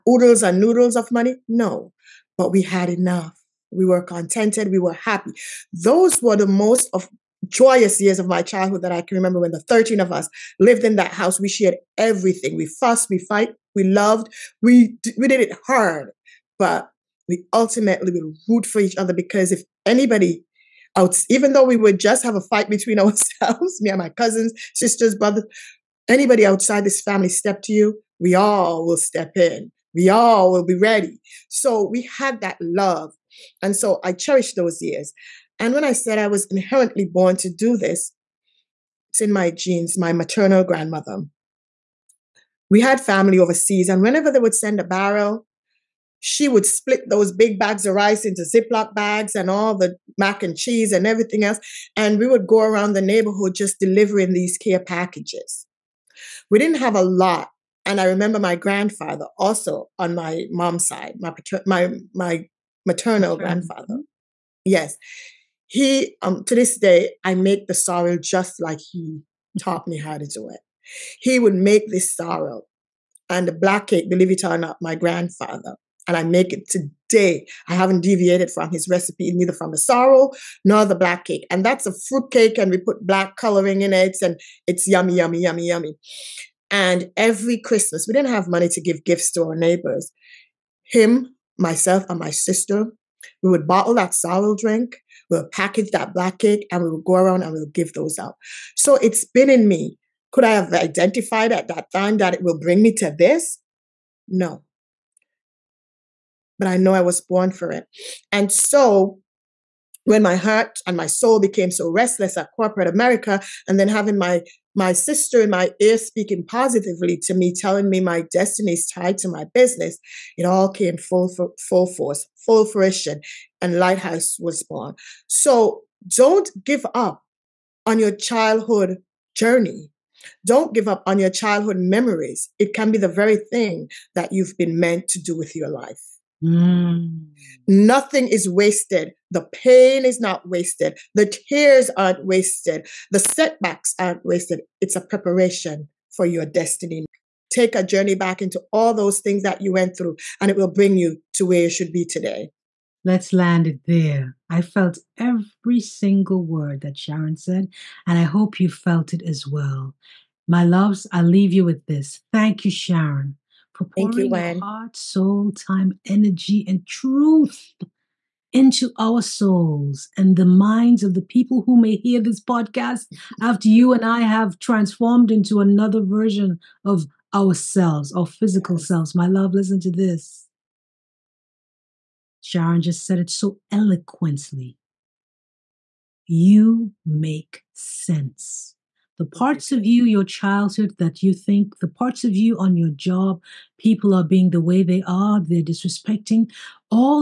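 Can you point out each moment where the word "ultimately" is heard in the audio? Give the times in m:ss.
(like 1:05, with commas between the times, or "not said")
0:17.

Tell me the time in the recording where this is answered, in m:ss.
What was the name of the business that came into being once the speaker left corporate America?
2:03.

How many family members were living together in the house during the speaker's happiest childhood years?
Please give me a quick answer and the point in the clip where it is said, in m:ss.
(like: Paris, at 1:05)
13, at 0:09.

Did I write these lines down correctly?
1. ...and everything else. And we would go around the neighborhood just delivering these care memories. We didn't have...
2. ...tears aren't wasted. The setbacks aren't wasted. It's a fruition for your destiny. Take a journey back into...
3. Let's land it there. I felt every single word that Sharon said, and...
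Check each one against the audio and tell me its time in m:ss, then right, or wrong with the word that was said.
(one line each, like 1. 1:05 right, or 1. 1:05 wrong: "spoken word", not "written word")
1. 0:50 wrong: "packages", not "memories"
2. 2:21 wrong: "preparation", not "fruition"
3. 2:33 right.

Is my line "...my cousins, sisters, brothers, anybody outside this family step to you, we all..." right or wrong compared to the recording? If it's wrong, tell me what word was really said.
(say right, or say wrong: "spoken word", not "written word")
right.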